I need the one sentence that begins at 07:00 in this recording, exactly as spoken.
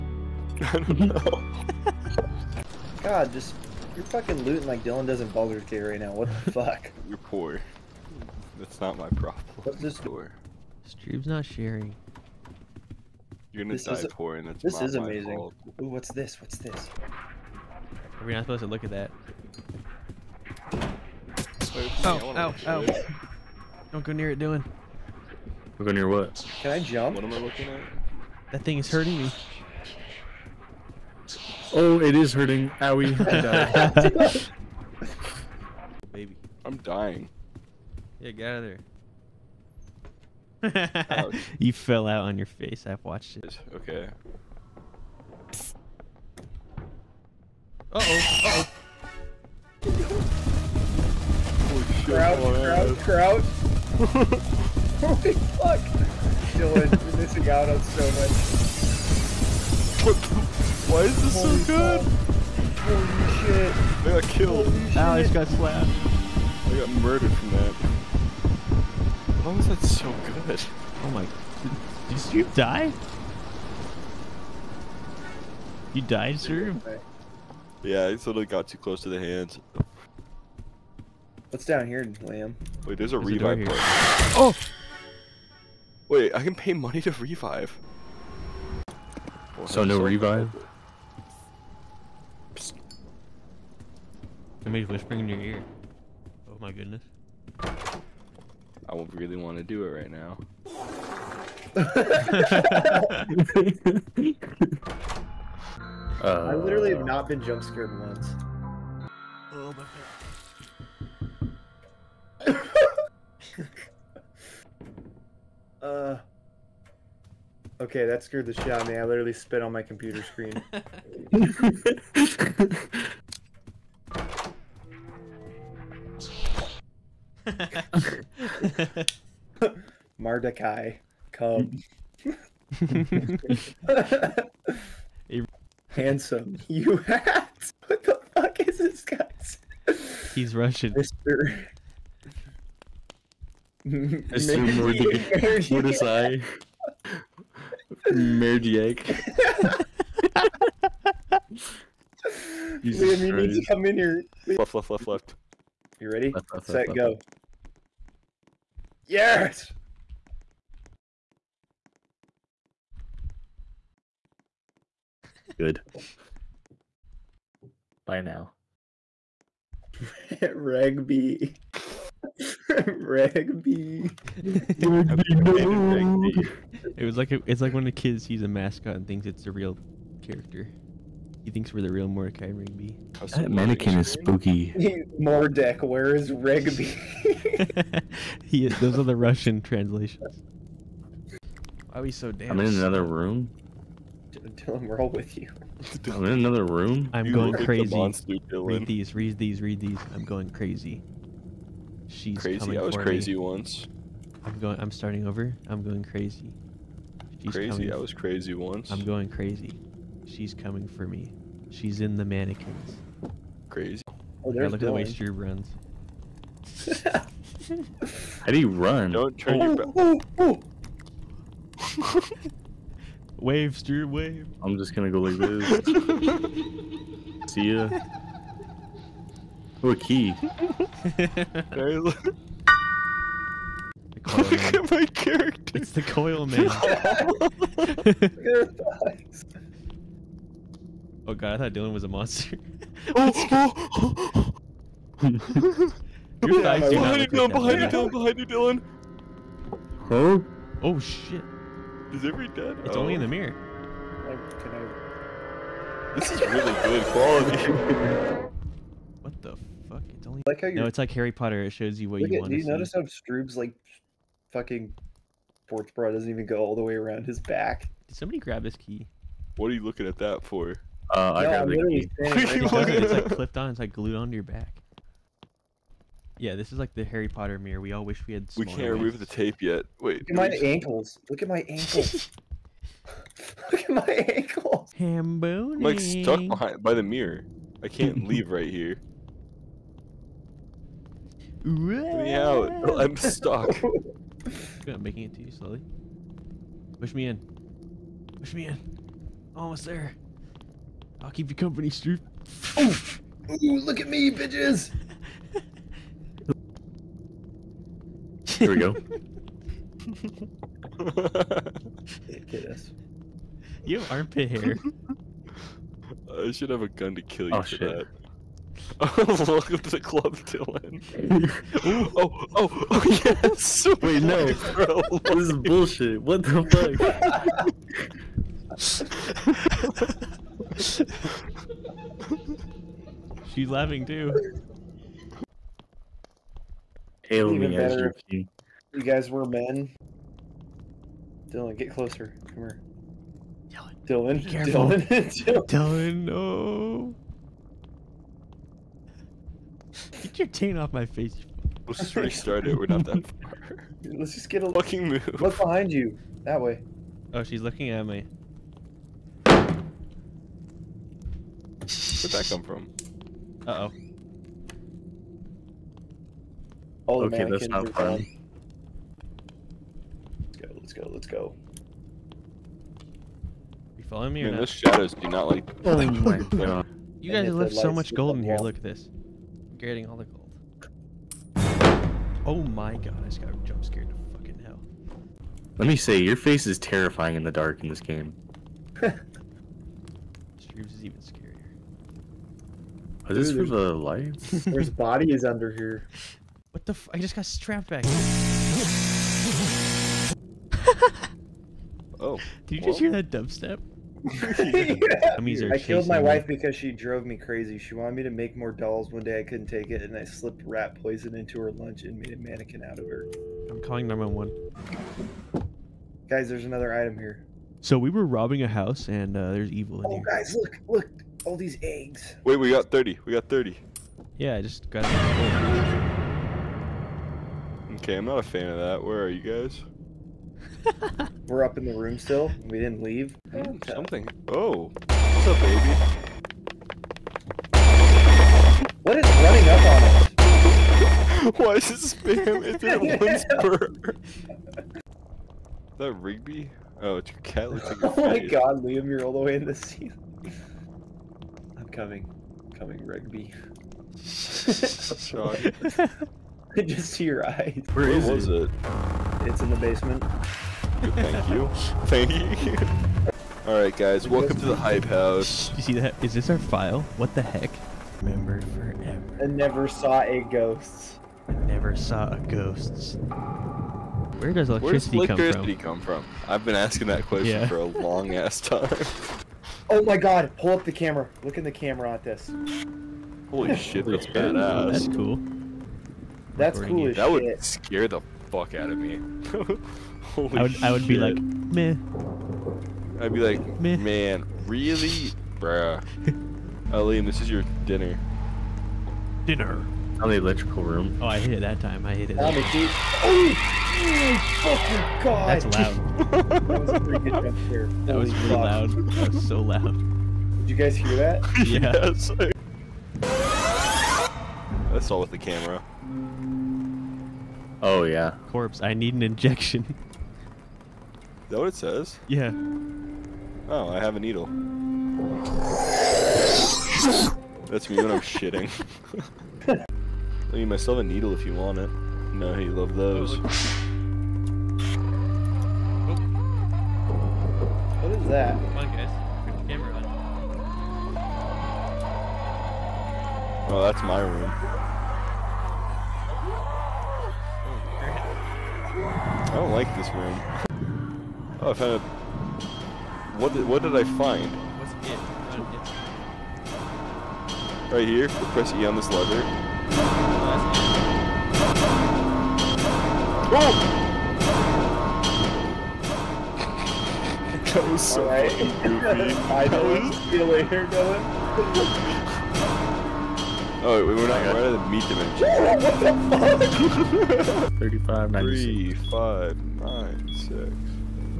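Oh, guys, look, look all these eggs.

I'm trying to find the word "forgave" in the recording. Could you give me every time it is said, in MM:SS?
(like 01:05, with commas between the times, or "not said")
not said.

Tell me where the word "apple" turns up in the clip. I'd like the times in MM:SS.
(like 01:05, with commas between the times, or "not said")
not said.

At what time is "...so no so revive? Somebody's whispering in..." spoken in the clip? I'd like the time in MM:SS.
01:29.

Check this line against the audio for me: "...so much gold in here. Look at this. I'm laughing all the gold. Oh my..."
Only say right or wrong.
wrong.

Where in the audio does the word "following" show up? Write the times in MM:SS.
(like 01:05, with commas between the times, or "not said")
06:14.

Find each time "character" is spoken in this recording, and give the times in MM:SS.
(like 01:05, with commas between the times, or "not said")
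03:00, 03:55.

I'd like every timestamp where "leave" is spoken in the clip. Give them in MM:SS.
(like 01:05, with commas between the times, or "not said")
04:48, 07:13.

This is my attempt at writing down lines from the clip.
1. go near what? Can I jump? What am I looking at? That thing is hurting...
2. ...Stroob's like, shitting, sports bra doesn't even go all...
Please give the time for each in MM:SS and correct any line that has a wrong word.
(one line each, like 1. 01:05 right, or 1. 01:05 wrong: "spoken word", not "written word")
1. 00:25 right
2. 04:23 wrong: "fucking", not "shitting".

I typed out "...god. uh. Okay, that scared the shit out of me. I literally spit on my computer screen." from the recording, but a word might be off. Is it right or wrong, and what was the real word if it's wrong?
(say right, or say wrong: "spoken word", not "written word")
right.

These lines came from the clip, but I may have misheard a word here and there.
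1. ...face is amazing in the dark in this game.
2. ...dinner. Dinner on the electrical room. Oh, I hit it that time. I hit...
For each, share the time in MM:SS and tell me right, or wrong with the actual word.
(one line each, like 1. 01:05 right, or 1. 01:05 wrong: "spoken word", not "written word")
1. 06:26 wrong: "terrifying", not "amazing"
2. 08:17 right.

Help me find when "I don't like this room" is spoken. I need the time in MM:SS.
09:09.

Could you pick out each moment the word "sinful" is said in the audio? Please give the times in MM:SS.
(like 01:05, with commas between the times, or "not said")
not said.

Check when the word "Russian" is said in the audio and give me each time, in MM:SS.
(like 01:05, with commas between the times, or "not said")
02:20, 03:09.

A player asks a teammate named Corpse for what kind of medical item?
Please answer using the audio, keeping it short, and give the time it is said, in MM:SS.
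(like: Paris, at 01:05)
An injection, at 08:38.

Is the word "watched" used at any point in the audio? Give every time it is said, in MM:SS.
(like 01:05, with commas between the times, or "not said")
00:43.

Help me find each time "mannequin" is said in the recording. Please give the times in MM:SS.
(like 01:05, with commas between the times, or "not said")
03:03, 03:32, 06:52.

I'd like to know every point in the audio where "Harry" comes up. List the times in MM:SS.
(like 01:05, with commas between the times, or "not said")
04:21, 04:37.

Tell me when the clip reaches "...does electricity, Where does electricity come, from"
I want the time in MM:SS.
07:54.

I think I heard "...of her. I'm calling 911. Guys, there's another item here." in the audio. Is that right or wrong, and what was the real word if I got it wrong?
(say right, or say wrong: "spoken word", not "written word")
right.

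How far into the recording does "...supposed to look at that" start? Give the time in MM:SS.
00:18.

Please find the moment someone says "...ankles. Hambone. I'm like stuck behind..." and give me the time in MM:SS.
04:44.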